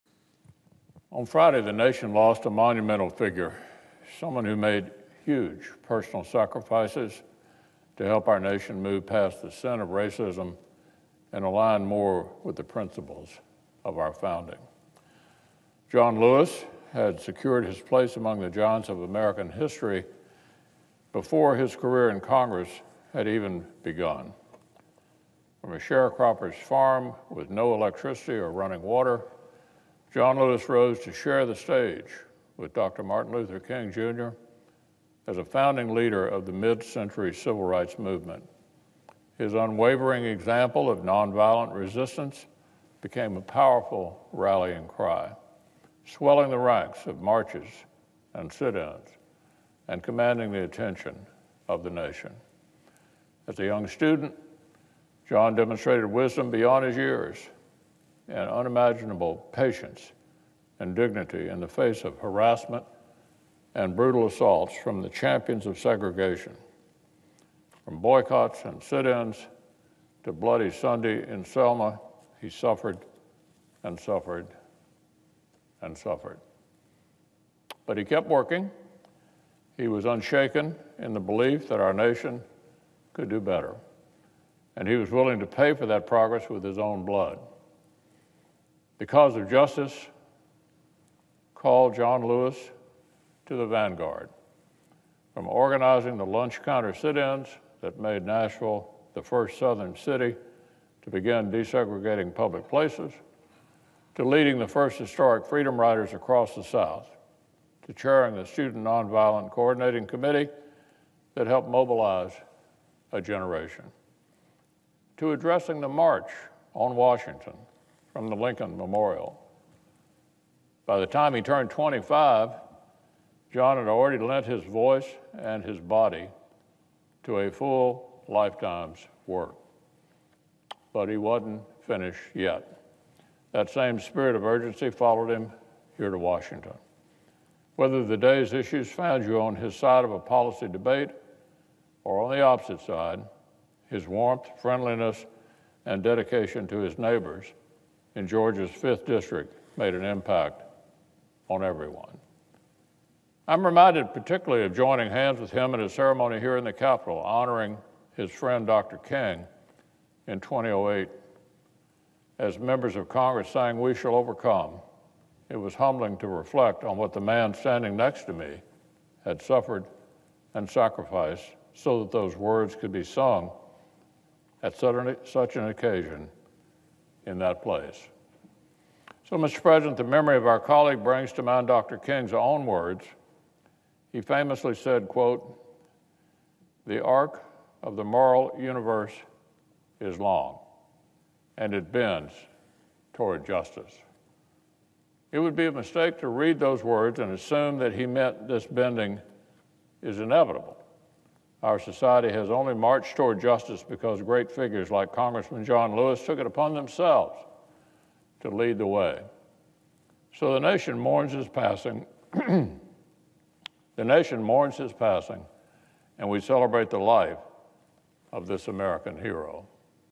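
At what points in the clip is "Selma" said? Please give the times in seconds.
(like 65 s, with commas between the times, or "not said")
71 s.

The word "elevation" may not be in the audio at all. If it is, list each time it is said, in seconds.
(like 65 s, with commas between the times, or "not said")
not said.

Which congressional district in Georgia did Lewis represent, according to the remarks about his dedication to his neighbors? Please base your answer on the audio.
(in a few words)
5th District.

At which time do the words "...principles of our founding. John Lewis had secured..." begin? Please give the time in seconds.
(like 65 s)
12 s.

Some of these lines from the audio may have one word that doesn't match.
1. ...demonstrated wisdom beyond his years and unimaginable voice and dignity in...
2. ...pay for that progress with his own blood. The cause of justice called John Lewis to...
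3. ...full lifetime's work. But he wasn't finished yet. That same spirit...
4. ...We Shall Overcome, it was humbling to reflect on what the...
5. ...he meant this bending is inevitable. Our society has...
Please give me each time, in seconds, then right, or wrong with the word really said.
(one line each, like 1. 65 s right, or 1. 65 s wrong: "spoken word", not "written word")
1. 55 s wrong: "patience", not "voice"
2. 85 s right
3. 127 s right
4. 163 s right
5. 197 s right.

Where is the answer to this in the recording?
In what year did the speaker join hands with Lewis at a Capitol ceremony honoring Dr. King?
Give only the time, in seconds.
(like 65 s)
160 s.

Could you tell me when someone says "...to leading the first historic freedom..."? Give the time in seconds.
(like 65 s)
104 s.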